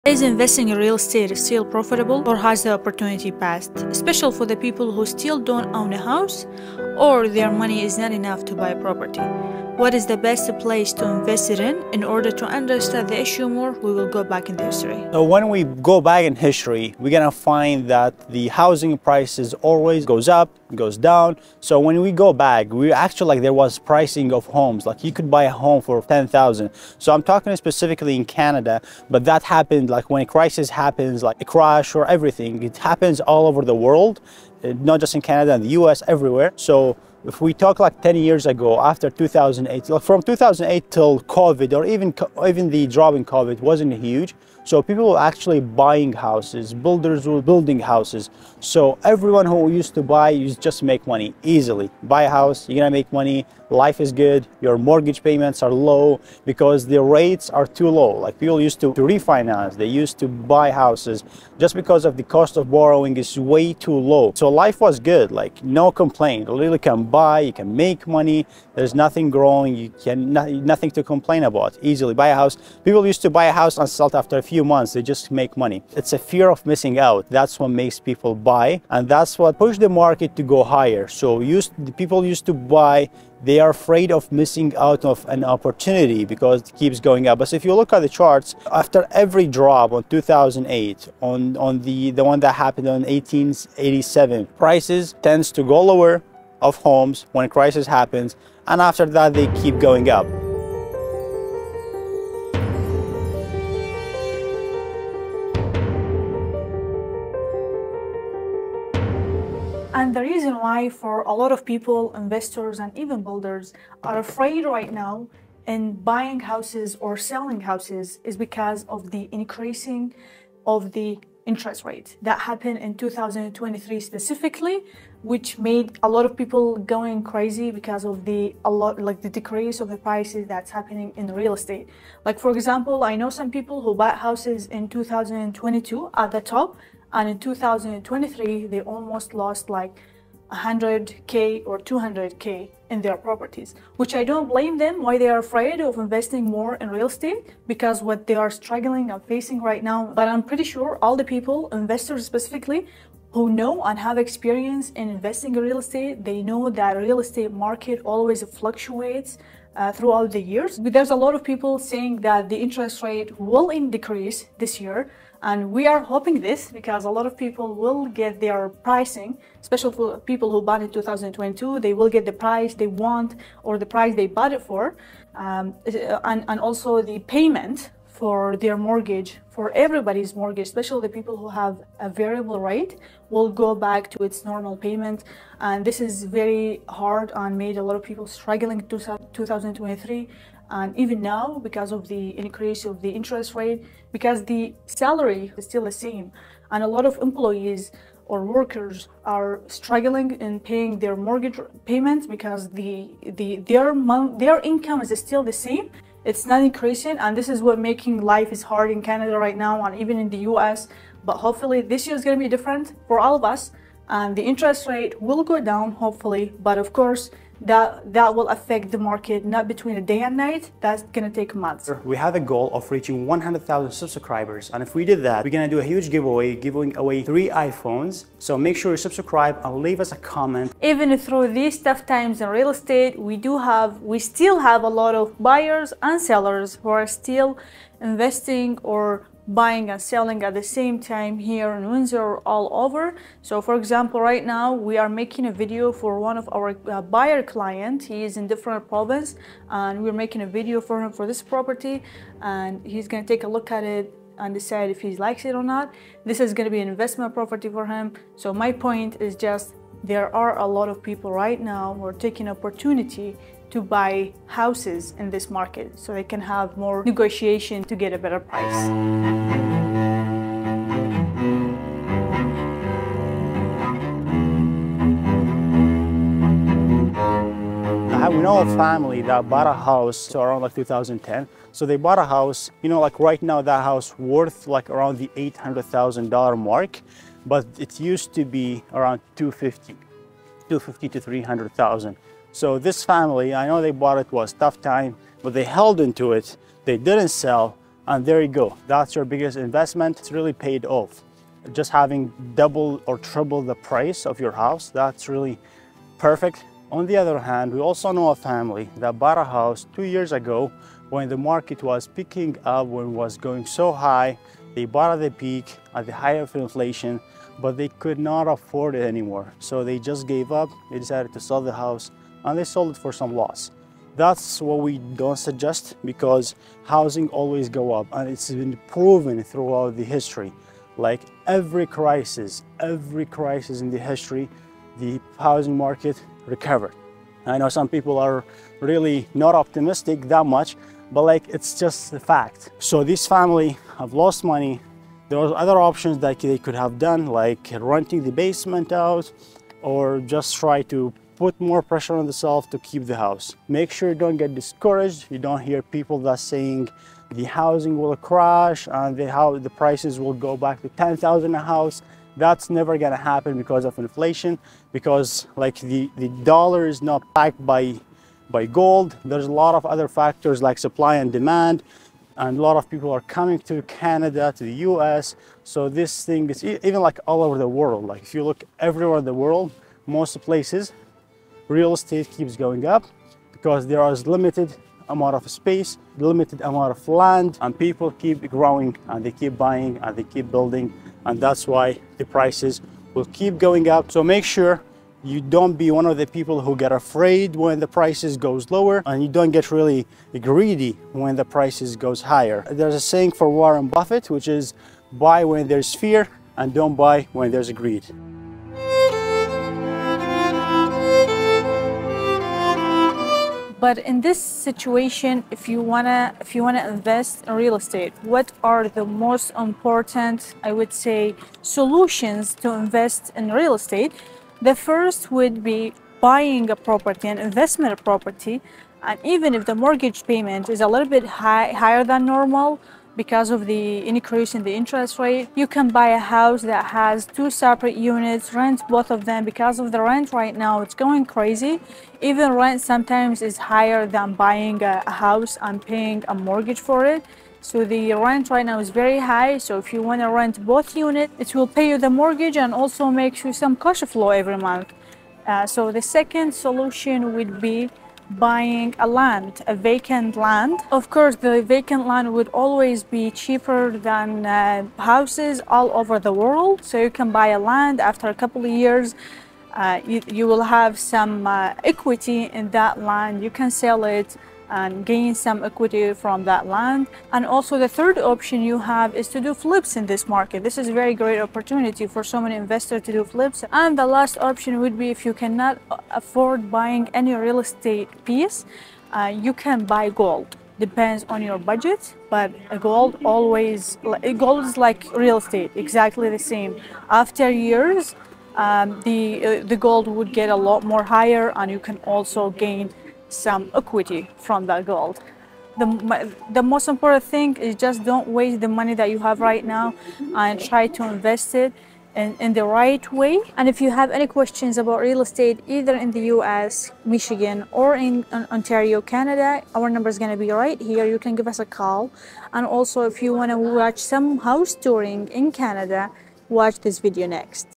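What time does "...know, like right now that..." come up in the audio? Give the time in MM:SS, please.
04:42.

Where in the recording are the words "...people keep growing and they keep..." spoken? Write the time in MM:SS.
06:27.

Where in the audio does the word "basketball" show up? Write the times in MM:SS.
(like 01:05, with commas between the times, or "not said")
not said.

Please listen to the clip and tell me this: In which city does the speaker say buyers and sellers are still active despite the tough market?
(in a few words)
Windsor.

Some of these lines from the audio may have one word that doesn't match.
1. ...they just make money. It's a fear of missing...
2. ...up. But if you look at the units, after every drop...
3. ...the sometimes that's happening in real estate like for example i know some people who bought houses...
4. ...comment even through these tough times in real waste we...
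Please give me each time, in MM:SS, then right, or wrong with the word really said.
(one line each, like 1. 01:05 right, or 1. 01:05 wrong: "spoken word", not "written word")
1. 01:14 right
2. 01:27 wrong: "charts", not "units"
3. 02:09 wrong: "prices", not "sometimes"
4. 03:50 wrong: "estate", not "waste".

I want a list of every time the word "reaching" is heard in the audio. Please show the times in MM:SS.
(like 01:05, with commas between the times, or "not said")
03:42.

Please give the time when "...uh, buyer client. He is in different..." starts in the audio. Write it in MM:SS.
04:06.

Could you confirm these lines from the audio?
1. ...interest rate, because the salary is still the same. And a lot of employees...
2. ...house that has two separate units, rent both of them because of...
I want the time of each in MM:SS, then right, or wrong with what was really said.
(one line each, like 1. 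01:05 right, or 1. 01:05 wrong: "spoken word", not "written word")
1. 03:13 right
2. 07:16 right.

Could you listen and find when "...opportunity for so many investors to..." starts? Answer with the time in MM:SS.
08:01.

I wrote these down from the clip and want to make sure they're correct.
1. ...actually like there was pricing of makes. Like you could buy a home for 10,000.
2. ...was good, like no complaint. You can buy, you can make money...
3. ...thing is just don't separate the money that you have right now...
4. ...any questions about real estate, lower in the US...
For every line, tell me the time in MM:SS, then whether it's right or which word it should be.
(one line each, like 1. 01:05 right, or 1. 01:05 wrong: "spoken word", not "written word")
1. 00:22 wrong: "homes", not "makes"
2. 01:04 right
3. 08:27 wrong: "waste", not "separate"
4. 08:34 wrong: "either", not "lower".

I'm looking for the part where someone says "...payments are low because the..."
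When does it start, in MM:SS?
00:55.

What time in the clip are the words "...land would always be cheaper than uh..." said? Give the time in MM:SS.
07:42.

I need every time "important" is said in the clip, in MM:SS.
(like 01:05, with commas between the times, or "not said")
06:59, 08:26.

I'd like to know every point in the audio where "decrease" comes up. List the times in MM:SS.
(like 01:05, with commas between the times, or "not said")
02:09, 02:43.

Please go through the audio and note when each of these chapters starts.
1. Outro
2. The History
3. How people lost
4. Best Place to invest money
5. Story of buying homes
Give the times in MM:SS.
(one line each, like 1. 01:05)
1. 08:34
2. 00:15
3. 01:50
4. 06:54
5. 04:39.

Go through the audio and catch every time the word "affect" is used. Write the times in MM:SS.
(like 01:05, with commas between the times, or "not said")
03:38.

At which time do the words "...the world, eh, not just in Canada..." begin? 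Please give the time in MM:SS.
00:33.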